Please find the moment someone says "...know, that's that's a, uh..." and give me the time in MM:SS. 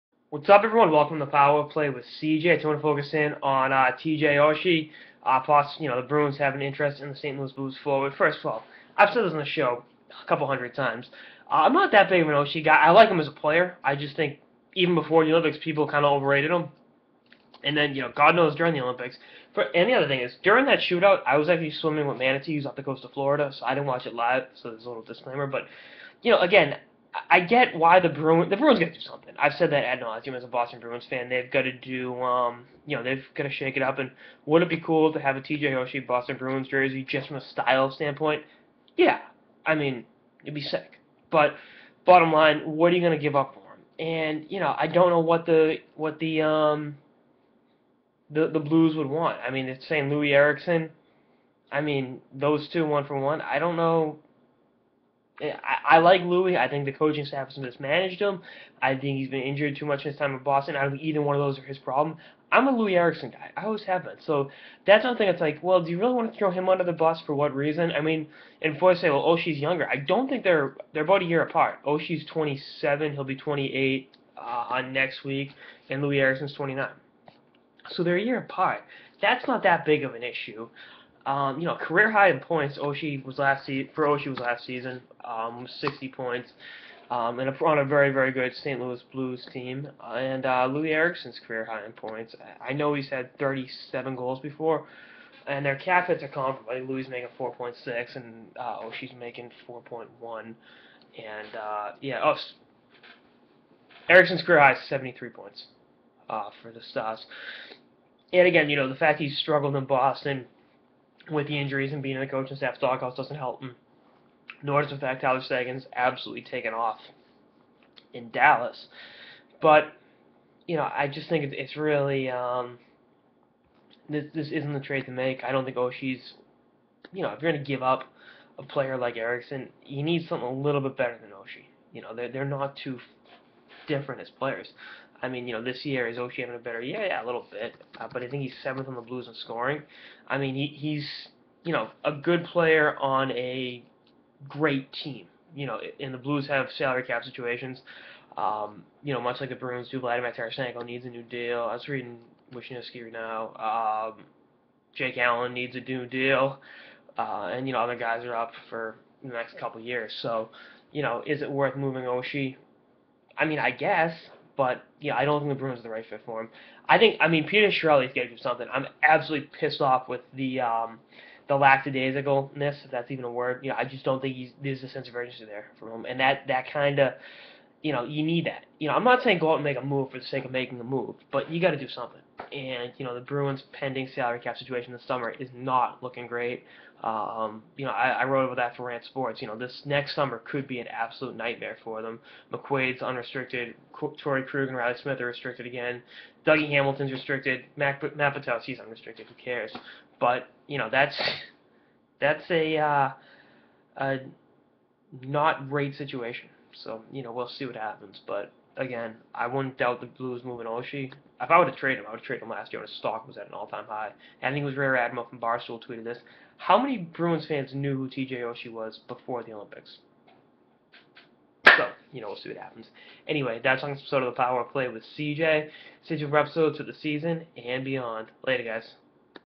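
03:20.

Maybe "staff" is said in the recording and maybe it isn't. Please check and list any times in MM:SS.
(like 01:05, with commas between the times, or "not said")
00:57, 01:52.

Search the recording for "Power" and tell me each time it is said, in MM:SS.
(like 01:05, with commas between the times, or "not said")
00:01, 03:44.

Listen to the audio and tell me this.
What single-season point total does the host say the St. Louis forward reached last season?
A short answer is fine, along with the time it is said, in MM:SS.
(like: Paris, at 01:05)
60 points, at 01:25.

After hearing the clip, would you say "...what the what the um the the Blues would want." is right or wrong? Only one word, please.
right.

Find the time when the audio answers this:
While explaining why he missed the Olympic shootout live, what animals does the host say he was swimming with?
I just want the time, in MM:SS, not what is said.
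00:22.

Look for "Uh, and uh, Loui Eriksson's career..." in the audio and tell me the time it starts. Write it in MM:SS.
01:30.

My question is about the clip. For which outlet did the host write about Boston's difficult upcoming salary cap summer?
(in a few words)
Rant Sports.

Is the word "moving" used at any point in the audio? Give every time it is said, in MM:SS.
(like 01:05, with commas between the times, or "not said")
02:41, 03:30.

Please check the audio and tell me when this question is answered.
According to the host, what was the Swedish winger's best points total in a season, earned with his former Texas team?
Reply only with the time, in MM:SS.
01:44.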